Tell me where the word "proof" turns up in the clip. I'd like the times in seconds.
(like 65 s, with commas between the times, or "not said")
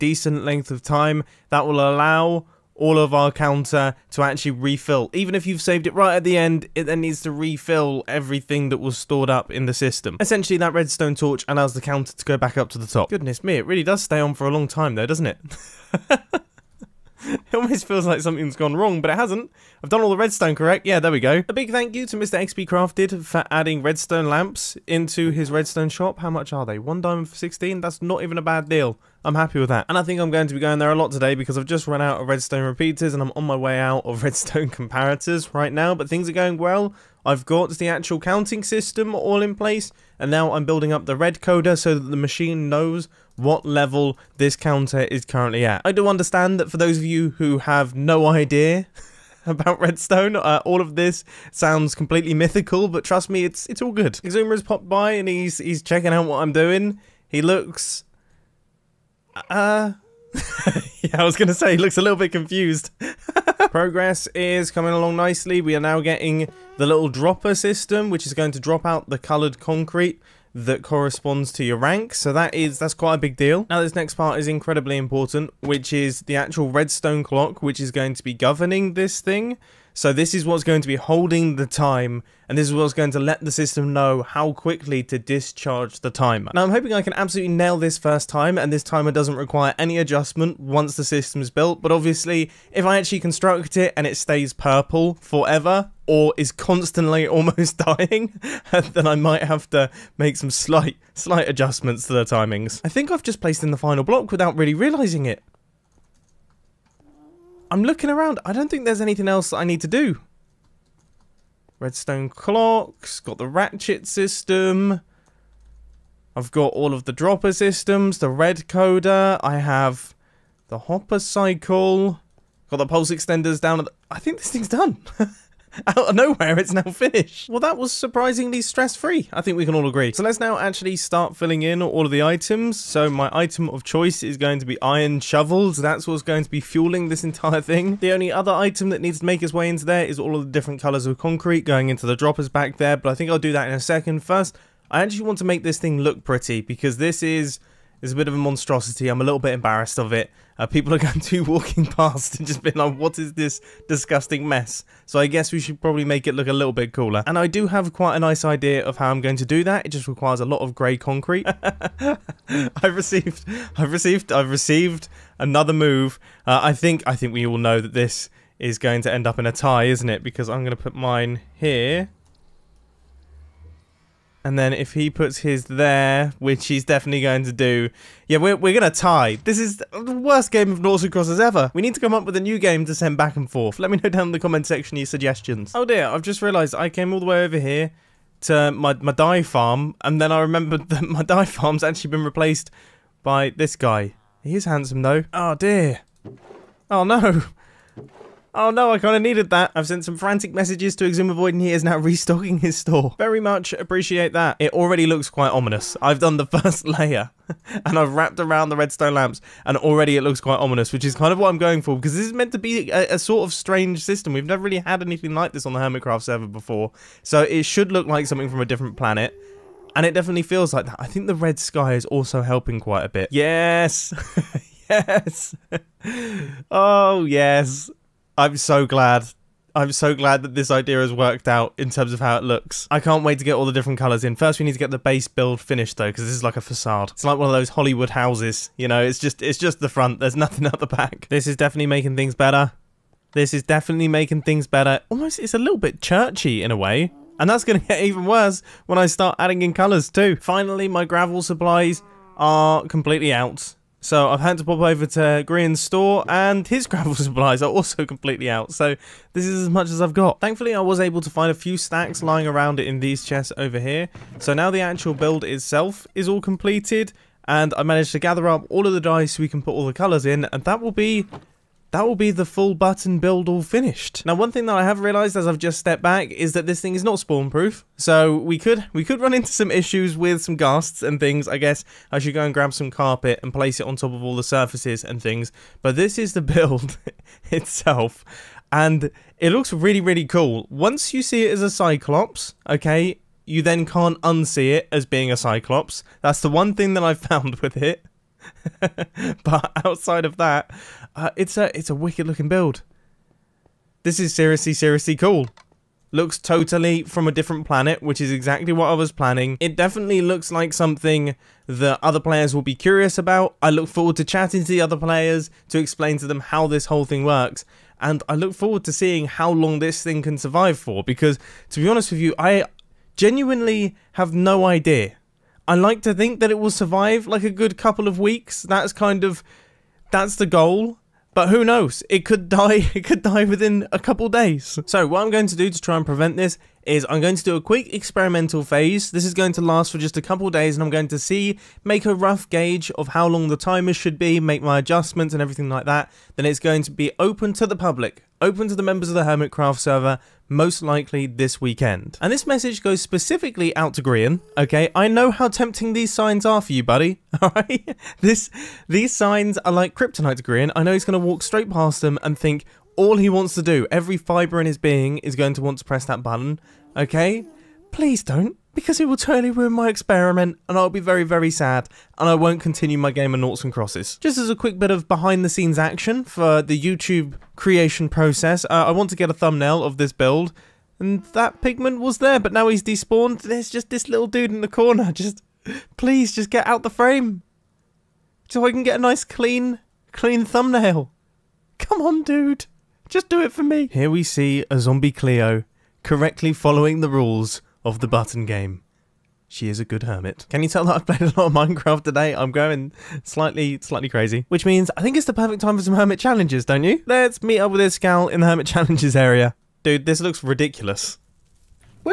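277 s.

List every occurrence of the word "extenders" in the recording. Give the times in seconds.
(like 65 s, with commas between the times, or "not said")
123 s.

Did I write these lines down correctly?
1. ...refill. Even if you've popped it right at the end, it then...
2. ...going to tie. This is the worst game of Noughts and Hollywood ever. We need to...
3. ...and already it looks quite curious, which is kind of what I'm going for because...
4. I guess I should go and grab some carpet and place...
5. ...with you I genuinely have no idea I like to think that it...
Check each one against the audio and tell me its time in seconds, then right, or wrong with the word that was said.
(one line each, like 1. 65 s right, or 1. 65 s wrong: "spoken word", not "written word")
1. 4 s wrong: "saved", not "popped"
2. 178 s wrong: "Crosses", not "Hollywood"
3. 209 s wrong: "ominous", not "curious"
4. 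281 s right
5. 322 s right.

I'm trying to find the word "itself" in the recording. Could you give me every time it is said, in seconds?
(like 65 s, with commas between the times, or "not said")
265 s, 287 s.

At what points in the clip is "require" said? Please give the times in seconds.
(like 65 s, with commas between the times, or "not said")
89 s, 160 s.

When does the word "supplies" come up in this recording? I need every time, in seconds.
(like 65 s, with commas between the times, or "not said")
251 s, 257 s.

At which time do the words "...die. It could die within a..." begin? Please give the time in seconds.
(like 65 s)
332 s.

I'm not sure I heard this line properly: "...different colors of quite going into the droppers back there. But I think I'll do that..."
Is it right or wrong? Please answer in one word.
wrong.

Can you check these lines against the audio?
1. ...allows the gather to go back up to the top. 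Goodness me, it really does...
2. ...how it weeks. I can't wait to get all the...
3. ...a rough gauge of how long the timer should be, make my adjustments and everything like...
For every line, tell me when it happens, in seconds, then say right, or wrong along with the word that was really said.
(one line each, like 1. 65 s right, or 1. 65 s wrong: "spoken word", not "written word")
1. 11 s wrong: "counter", not "gather"
2. 232 s wrong: "looks", not "weeks"
3. 342 s right.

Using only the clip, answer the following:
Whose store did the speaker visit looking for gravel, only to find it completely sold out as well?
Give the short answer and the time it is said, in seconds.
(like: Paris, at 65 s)
Green's store, at 255 s.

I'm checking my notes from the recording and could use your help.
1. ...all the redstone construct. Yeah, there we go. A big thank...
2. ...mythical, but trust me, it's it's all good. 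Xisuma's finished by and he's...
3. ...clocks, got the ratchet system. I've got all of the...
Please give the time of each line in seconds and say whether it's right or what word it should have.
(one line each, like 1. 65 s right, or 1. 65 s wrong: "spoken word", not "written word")
1. 20 s wrong: "correct", not "construct"
2. 52 s wrong: "popped", not "finished"
3. 112 s right.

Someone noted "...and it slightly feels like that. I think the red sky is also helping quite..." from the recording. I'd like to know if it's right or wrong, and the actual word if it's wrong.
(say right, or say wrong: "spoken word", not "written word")
wrong: "definitely", not "slightly".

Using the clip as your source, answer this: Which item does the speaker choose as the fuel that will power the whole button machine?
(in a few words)
Iron shovels.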